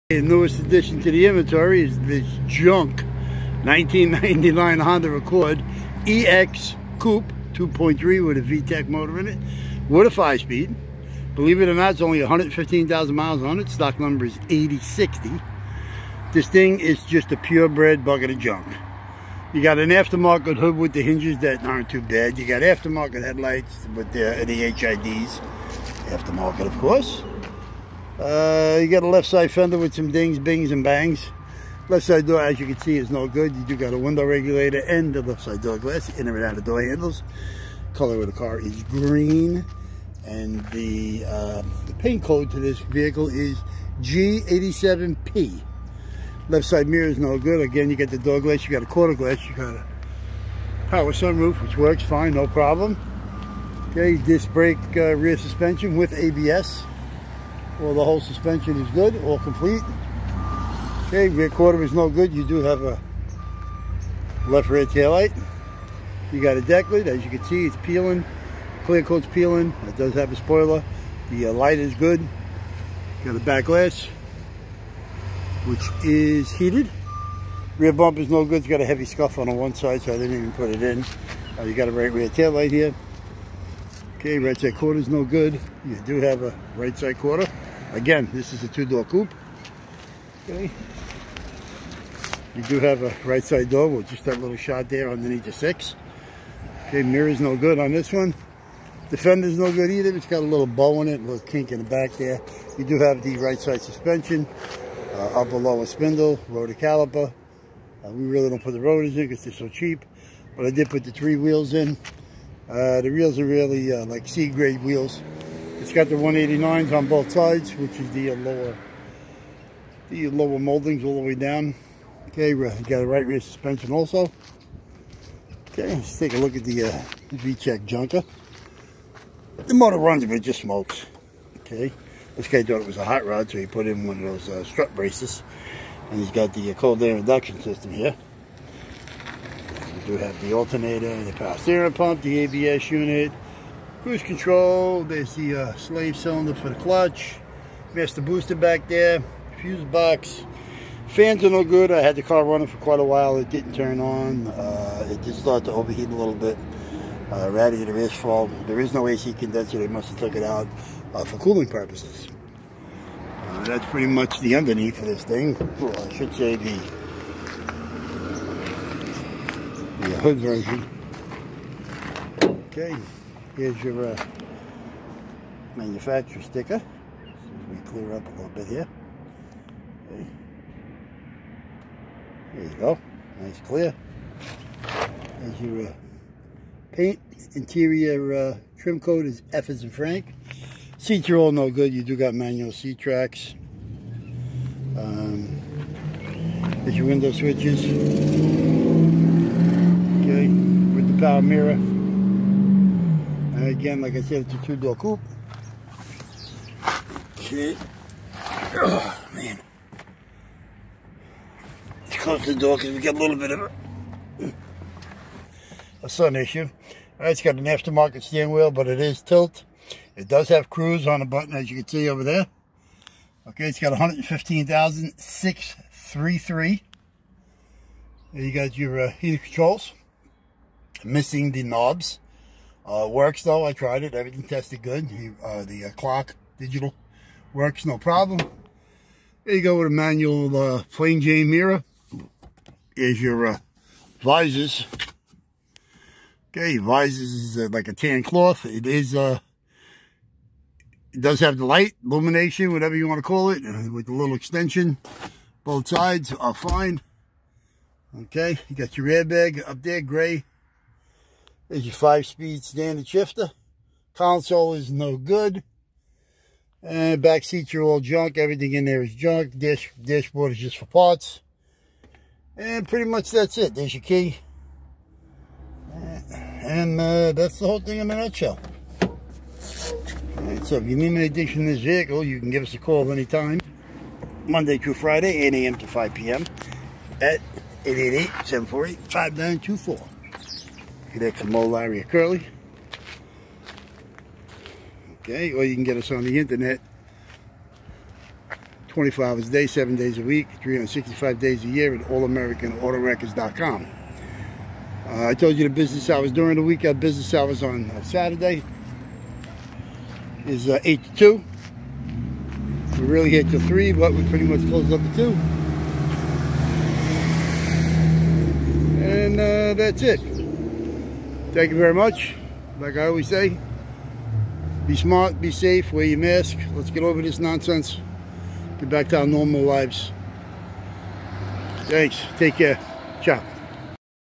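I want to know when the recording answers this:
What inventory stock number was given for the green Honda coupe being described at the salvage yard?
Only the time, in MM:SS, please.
00:13.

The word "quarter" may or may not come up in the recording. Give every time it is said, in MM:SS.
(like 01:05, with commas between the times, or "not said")
00:48, 01:01, 01:27.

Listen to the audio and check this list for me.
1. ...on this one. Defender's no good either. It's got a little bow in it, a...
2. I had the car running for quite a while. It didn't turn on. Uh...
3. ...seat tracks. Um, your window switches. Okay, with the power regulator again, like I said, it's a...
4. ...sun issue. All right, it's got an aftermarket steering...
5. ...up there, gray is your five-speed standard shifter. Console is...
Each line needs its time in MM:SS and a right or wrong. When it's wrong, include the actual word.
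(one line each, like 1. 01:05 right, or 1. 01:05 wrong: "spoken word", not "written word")
1. 01:37 right
2. 02:31 right
3. 03:12 wrong: "mirror", not "regulator"
4. 03:36 right
5. 04:19 right.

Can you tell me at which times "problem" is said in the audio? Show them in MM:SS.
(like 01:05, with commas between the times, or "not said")
00:52, 03:57.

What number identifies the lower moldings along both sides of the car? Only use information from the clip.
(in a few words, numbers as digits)
189.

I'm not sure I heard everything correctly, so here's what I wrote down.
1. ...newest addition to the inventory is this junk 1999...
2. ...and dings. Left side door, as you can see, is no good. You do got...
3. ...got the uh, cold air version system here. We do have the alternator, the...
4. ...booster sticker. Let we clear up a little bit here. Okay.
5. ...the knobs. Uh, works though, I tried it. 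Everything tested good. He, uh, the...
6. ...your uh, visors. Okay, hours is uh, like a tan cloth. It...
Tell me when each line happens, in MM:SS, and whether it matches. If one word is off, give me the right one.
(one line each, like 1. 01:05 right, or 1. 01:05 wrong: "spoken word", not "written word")
1. 00:00 right
2. 00:30 wrong: "bangs", not "dings"
3. 02:16 wrong: "induction", not "version"
4. 02:55 wrong: "manufacturer", not "booster"
5. 03:51 right
6. 04:03 wrong: "visors", not "hours".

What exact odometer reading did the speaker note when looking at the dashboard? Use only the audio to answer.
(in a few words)
115,633.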